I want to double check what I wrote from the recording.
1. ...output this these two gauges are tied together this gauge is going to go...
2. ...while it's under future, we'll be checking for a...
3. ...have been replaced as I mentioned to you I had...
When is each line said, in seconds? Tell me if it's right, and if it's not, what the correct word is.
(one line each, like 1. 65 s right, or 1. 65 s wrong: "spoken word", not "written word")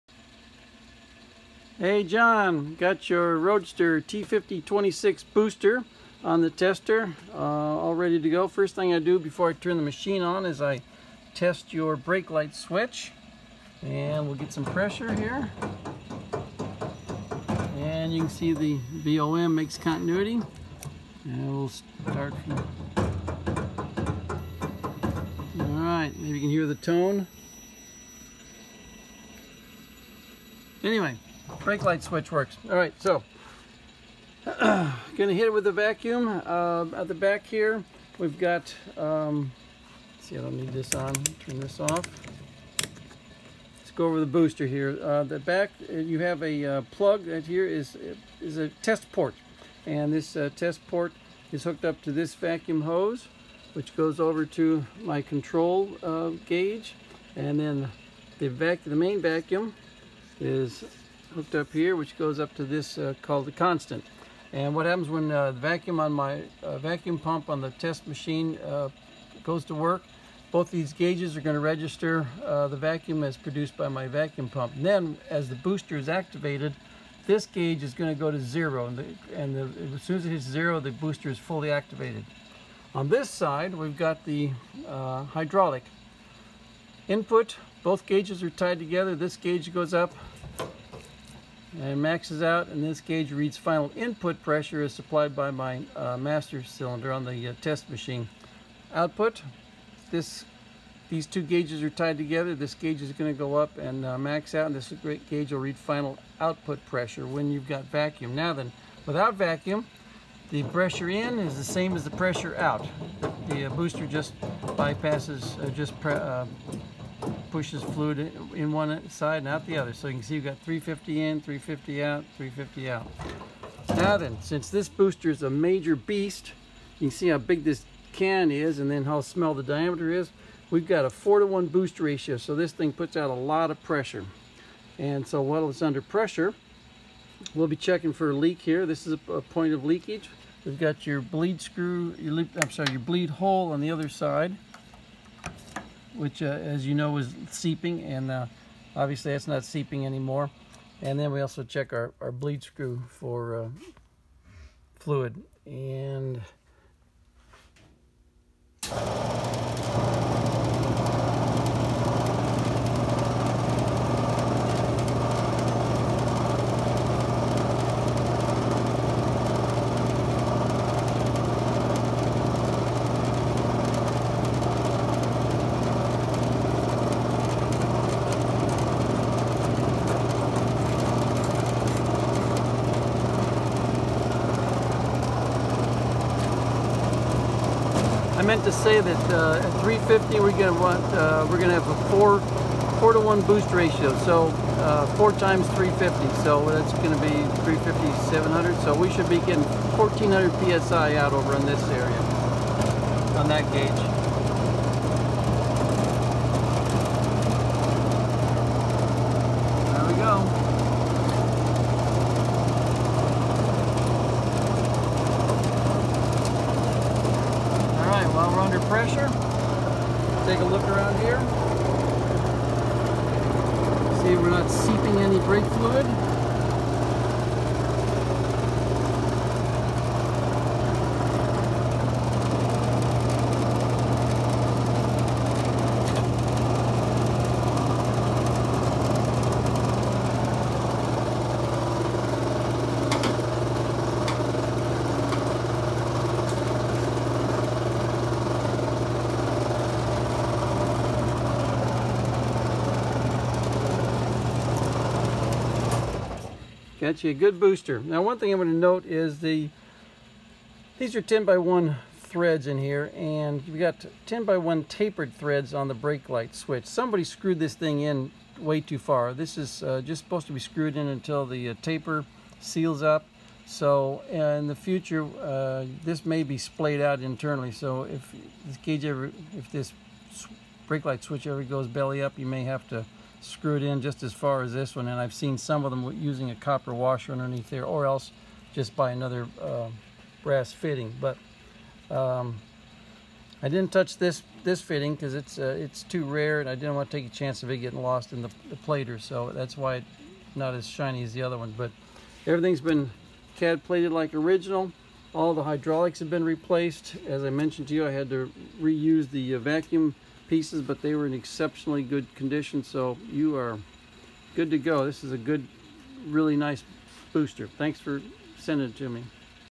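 1. 98 s right
2. 135 s wrong: "pressure", not "future"
3. 306 s right.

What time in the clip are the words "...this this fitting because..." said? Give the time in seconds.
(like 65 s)
294 s.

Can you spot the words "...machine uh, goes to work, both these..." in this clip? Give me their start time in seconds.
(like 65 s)
68 s.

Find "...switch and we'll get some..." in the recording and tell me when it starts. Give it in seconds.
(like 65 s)
12 s.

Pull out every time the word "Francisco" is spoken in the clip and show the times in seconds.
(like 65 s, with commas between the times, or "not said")
not said.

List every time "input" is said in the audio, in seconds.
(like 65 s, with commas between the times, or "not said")
87 s, 93 s.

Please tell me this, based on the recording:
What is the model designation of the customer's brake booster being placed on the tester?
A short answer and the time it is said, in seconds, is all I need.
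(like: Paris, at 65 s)
Roadster T5026, at 3 s.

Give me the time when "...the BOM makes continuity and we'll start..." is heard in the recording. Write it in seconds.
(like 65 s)
18 s.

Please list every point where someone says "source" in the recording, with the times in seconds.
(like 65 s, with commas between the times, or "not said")
not said.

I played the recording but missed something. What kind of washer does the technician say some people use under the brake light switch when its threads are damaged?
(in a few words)
copper washer.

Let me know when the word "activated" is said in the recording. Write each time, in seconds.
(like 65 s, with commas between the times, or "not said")
76 s, 81 s.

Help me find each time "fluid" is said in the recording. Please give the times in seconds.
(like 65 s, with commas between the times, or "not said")
117 s, 154 s, 225 s.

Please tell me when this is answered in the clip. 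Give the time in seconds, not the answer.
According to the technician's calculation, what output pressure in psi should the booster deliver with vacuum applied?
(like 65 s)
199 s.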